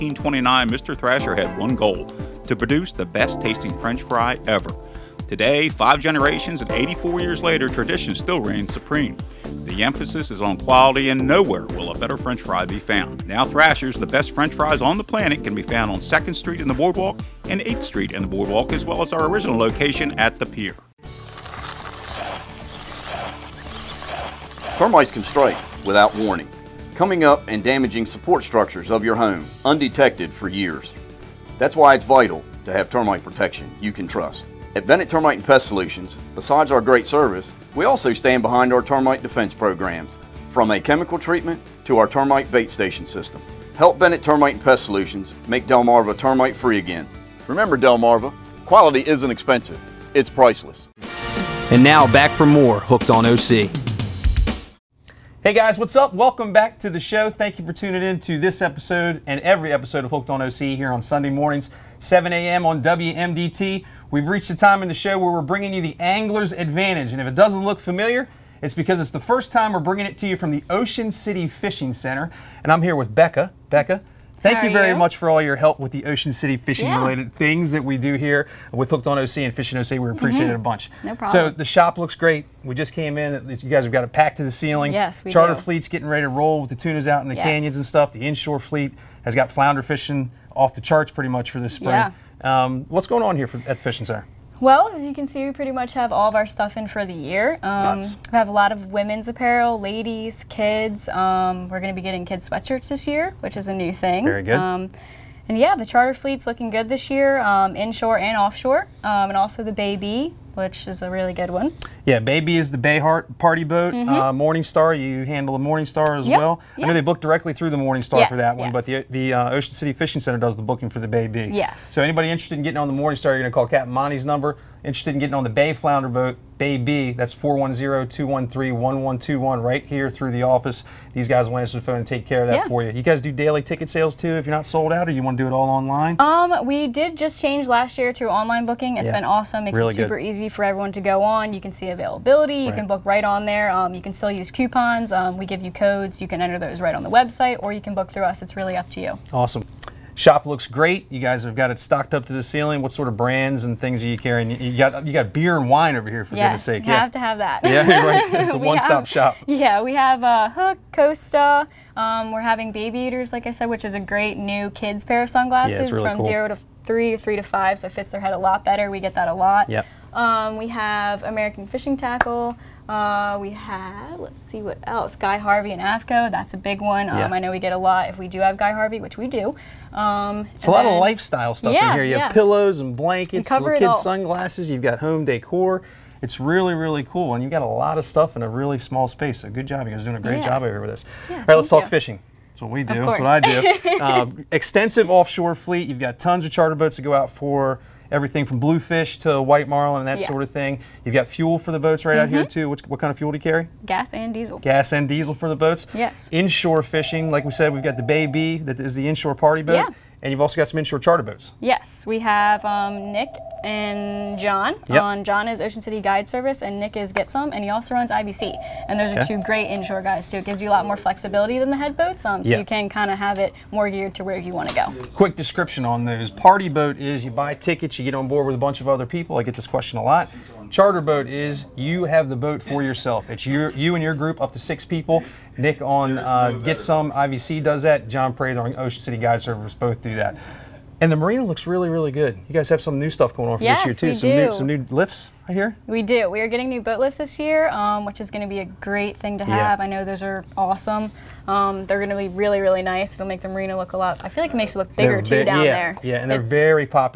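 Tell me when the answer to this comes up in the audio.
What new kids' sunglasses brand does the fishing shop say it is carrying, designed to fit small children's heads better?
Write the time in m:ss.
2:42.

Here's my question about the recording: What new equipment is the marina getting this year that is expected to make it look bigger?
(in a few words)
Boat lifts.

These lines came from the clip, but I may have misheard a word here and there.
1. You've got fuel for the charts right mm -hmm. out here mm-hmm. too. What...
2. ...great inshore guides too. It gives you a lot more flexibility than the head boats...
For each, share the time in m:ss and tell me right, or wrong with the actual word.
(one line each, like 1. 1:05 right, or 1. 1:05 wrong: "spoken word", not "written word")
1. 3:21 wrong: "boats", not "charts"
2. 3:39 right.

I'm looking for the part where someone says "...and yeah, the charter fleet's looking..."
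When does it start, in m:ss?
1:45.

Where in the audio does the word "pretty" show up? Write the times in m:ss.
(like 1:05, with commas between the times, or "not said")
1:31, 1:35.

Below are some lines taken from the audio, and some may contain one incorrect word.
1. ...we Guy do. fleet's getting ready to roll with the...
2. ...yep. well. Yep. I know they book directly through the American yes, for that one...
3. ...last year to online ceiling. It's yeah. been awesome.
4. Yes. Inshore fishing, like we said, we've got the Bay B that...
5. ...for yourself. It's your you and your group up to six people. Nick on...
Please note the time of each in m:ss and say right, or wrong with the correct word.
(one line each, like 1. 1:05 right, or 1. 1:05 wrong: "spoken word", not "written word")
1. 1:25 wrong: "Charter", not "Guy"
2. 1:56 wrong: "Morningstar", not "American"
3. 2:17 wrong: "booking", not "ceiling"
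4. 3:25 right
5. 3:52 right.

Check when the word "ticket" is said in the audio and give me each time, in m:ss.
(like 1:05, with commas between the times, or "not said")
2:13, 3:47.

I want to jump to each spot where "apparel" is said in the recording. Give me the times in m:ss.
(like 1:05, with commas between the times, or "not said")
1:39.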